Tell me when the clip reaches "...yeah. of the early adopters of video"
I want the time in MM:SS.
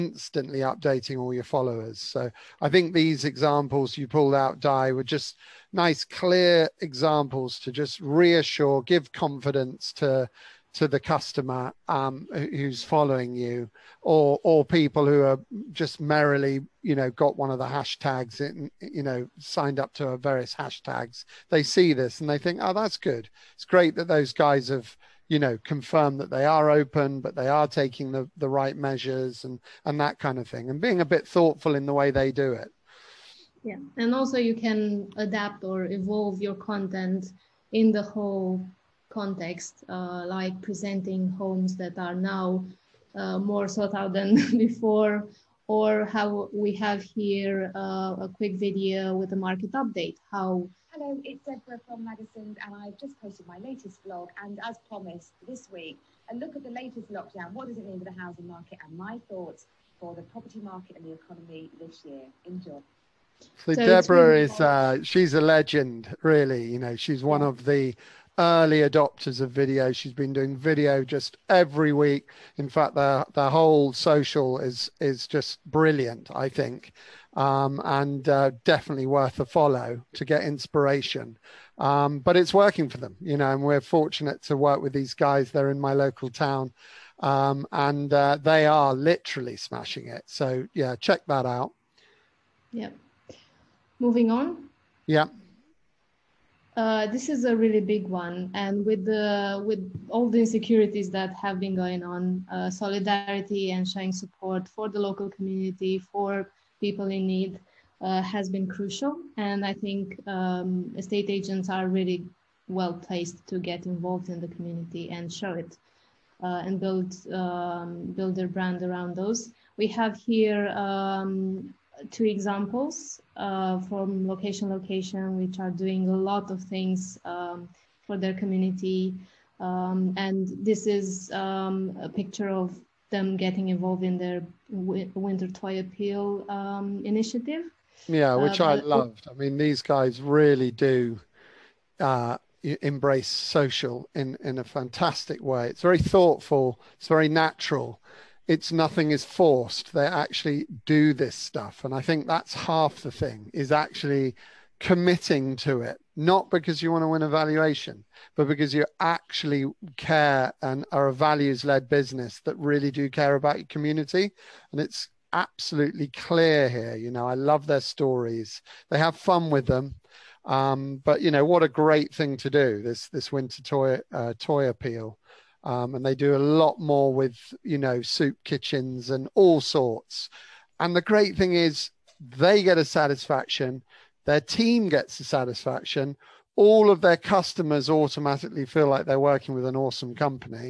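01:07.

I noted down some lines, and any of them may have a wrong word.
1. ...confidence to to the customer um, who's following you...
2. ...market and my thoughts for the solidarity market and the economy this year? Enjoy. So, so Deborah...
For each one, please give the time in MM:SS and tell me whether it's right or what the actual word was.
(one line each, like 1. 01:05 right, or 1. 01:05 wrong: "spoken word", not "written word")
1. 00:09 right
2. 00:58 wrong: "property", not "solidarity".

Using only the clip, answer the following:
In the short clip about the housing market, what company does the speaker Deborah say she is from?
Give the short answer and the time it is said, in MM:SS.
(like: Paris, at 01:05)
Magazines, at 00:52.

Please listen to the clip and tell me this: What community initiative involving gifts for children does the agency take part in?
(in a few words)
Winter Toy Appeal.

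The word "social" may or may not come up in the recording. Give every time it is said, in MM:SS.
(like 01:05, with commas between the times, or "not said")
01:13, 02:23.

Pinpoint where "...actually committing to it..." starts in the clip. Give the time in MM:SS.
02:33.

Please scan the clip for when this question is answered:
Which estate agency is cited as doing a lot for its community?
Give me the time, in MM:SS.
02:04.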